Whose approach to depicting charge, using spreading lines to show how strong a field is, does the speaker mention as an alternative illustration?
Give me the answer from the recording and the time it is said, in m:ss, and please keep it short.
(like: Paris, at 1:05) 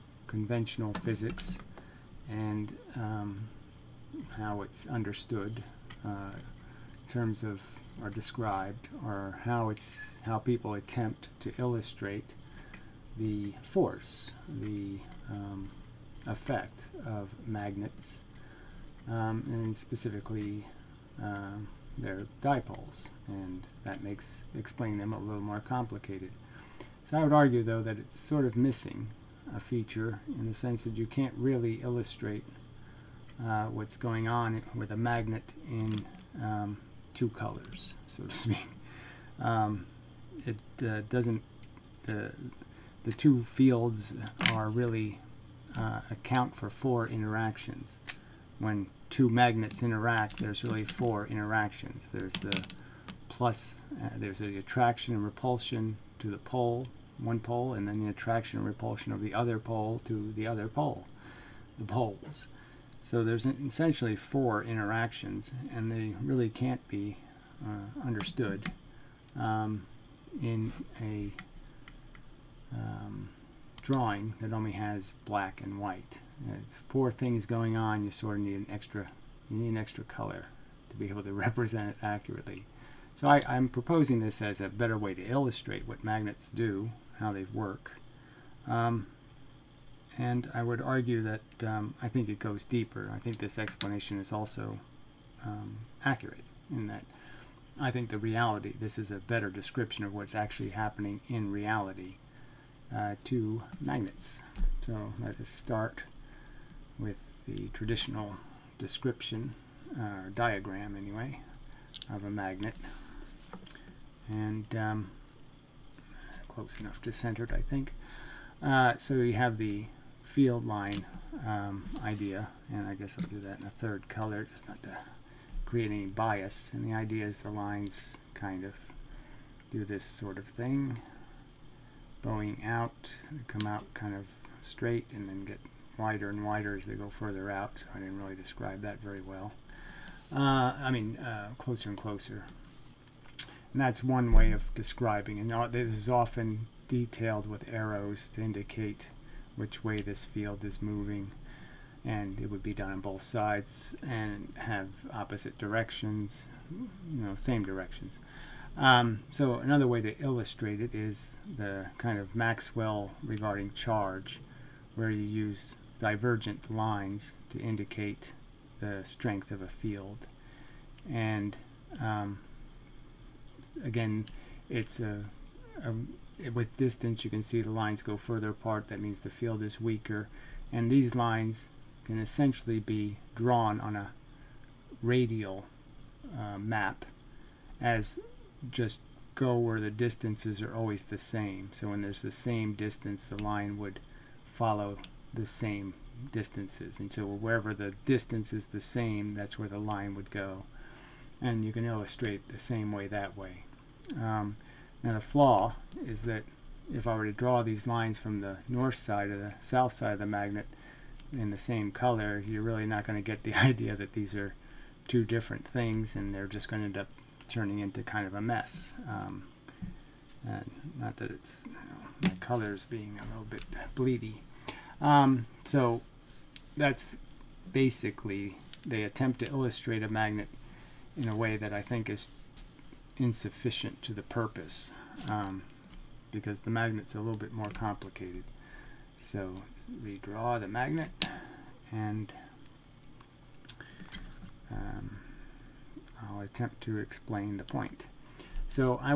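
Maxwell, at 2:42.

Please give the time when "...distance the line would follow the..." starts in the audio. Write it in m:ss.
3:12.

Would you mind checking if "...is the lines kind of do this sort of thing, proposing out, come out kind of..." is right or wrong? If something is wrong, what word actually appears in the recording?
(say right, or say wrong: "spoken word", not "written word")
wrong: "bowing", not "proposing".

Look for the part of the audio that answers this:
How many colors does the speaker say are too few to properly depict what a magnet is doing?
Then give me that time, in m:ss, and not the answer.
0:37.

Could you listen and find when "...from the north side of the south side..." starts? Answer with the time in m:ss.
3:28.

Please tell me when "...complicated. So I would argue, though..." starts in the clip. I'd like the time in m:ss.
0:25.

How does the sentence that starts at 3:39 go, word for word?
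Um, not that it's you know, the colors being a little bit bleedy.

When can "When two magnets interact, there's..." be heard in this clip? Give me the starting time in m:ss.
0:48.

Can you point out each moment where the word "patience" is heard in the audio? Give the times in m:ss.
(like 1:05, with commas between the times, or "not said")
not said.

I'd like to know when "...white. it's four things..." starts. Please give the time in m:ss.
1:15.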